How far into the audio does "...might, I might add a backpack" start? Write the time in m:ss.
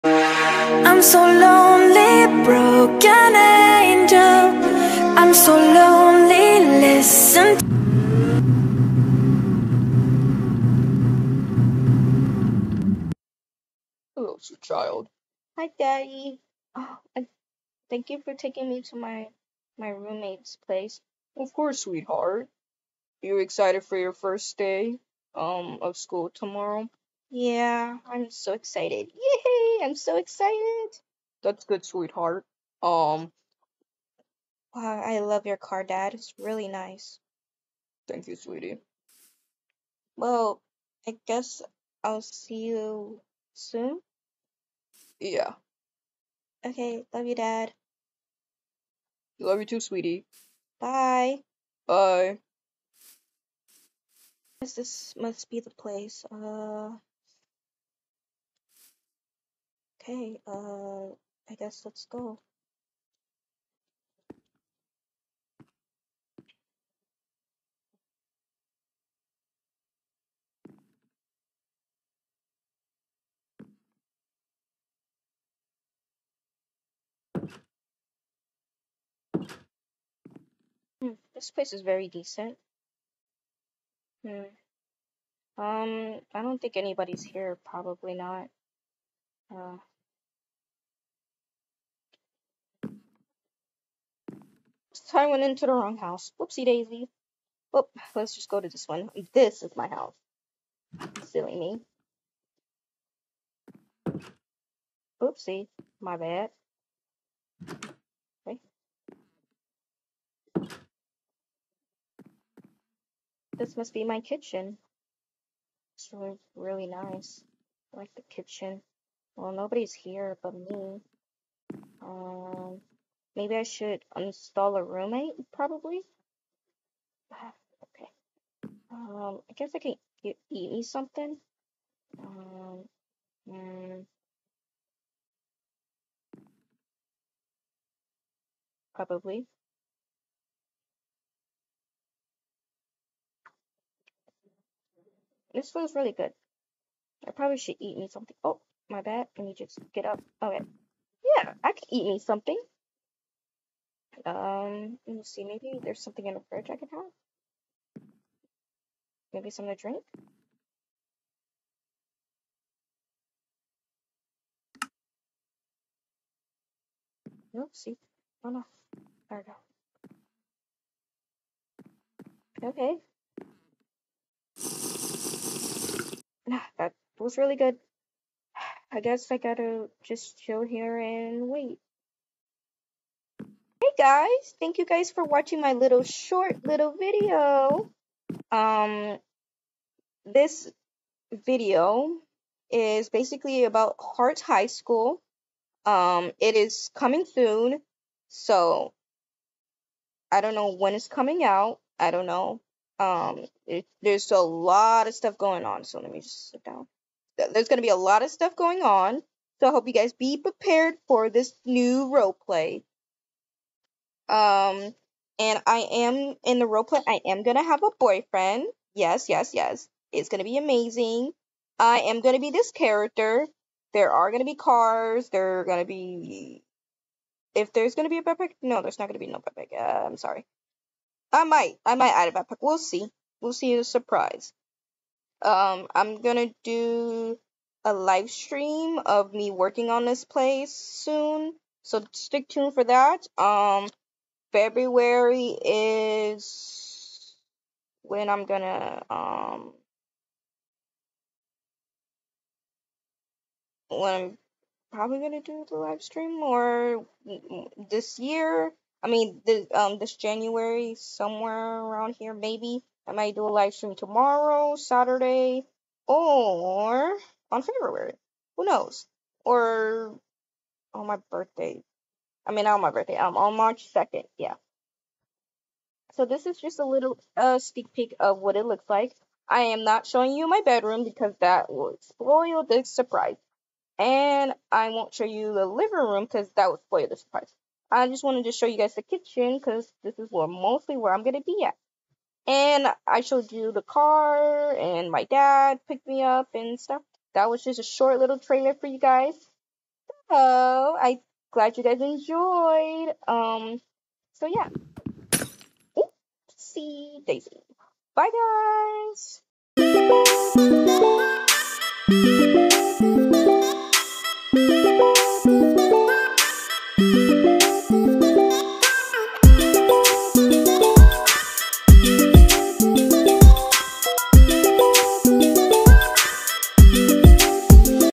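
3:51.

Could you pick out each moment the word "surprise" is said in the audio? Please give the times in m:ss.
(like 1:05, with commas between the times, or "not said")
3:53, 4:42, 4:47.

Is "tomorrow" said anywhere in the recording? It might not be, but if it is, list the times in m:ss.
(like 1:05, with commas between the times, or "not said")
0:26, 4:23.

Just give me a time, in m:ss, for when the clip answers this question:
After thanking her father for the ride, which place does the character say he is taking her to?
0:19.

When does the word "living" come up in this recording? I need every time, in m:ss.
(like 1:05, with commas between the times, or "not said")
4:45.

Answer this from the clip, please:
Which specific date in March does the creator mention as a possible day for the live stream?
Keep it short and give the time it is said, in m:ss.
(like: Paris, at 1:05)
March 2, at 4:33.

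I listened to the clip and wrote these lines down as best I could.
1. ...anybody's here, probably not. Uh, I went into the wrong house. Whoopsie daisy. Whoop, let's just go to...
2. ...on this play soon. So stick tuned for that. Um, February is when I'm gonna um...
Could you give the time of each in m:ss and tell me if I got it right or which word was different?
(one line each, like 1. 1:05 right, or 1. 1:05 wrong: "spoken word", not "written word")
1. 1:26 right
2. 3:59 right.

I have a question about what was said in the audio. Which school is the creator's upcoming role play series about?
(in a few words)
Hart High School.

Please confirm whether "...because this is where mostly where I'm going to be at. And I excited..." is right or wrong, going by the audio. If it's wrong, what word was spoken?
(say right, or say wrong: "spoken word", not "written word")
wrong: "showed", not "excited".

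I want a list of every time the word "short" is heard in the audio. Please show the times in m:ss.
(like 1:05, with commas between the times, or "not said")
3:06, 4:57.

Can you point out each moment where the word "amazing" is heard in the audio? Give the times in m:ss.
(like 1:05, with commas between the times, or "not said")
3:40.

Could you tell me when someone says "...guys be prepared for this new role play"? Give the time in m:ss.
3:29.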